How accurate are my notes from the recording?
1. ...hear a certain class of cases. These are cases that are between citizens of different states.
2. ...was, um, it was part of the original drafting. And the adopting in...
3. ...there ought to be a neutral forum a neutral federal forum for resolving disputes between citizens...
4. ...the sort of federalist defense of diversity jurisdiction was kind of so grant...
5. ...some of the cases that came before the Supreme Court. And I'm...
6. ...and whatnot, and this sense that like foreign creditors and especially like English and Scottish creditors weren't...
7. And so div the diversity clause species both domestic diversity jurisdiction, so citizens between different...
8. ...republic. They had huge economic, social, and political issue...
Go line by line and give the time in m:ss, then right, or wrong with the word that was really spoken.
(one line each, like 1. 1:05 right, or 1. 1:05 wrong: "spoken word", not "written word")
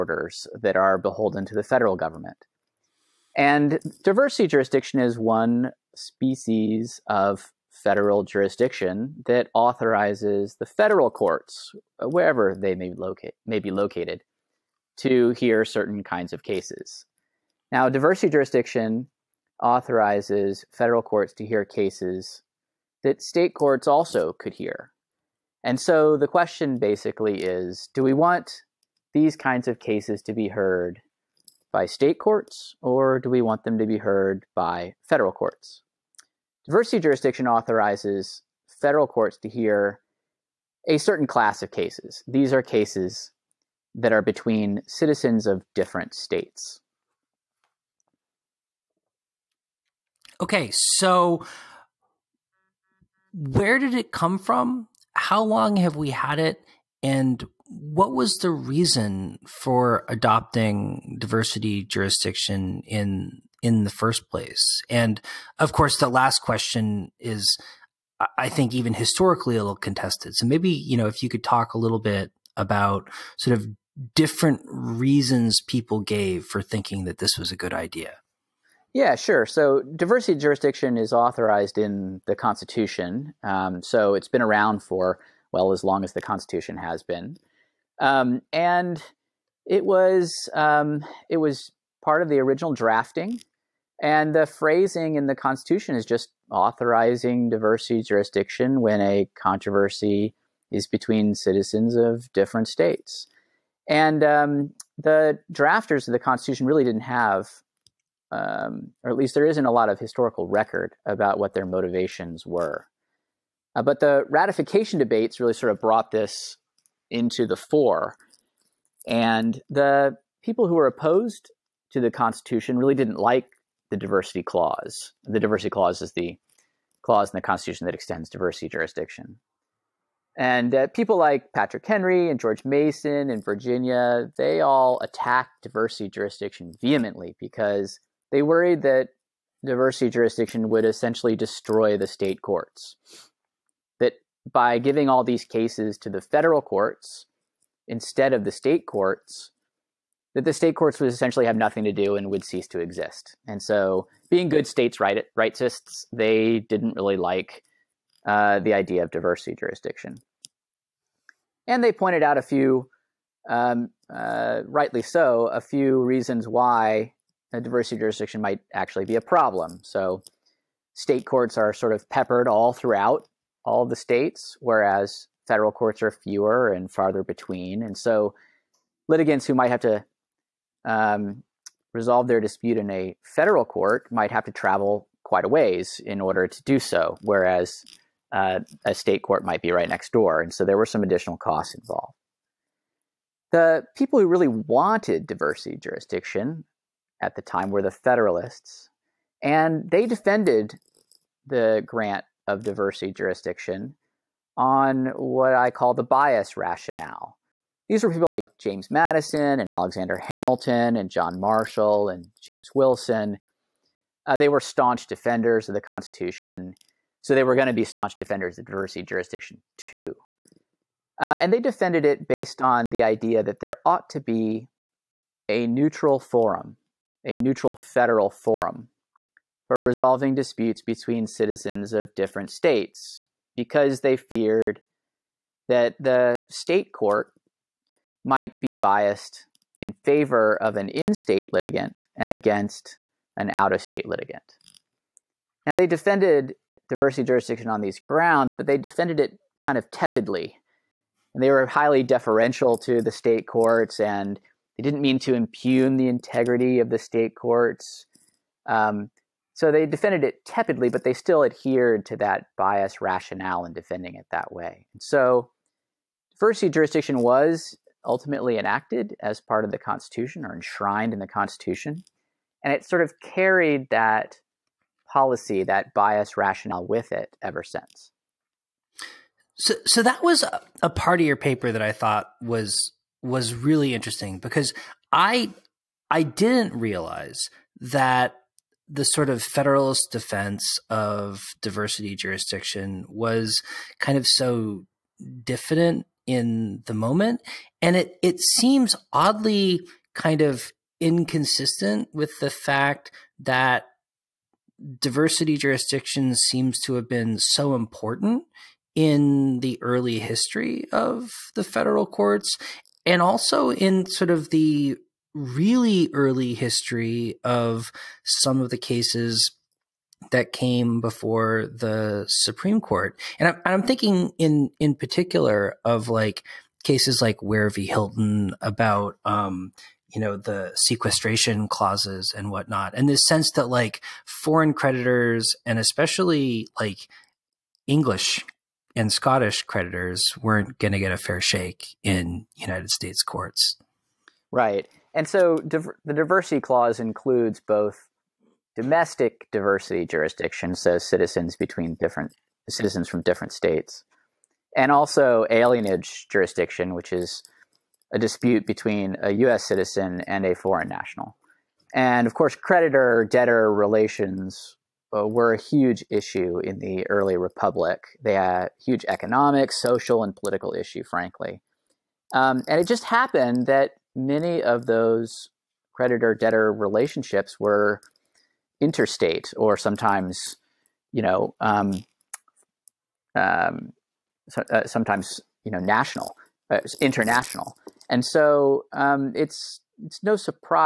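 1. 0:39 right
2. 1:29 wrong: "phrasing", not "adopting"
3. 3:43 right
4. 4:48 wrong: "diffident", not "grant"
5. 5:18 right
6. 5:32 right
7. 5:45 wrong: "includes", not "species"
8. 6:07 right.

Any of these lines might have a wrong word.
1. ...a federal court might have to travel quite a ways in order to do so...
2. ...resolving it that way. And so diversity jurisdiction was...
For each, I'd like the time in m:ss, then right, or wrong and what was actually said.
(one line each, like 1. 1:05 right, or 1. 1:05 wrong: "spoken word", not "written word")
1. 3:02 right
2. 4:23 wrong: "defending", not "resolving".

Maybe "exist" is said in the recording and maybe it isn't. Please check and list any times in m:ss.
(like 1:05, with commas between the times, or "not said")
2:32.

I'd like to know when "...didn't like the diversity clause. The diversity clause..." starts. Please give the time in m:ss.
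2:02.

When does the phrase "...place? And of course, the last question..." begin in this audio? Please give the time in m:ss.
1:04.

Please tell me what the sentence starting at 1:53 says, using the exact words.
Uh, but the ratification debates really sort of brought this into the fore.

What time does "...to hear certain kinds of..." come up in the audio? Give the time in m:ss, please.
0:14.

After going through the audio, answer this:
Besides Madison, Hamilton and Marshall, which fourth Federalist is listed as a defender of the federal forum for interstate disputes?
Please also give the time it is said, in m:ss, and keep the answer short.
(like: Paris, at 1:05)
James Wilson, at 3:32.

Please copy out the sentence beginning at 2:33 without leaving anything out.
And so, being good states right, rightists, they didn't really like uh, the idea of diversity jurisdiction.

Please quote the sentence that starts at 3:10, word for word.
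And so there were some additional costs involved.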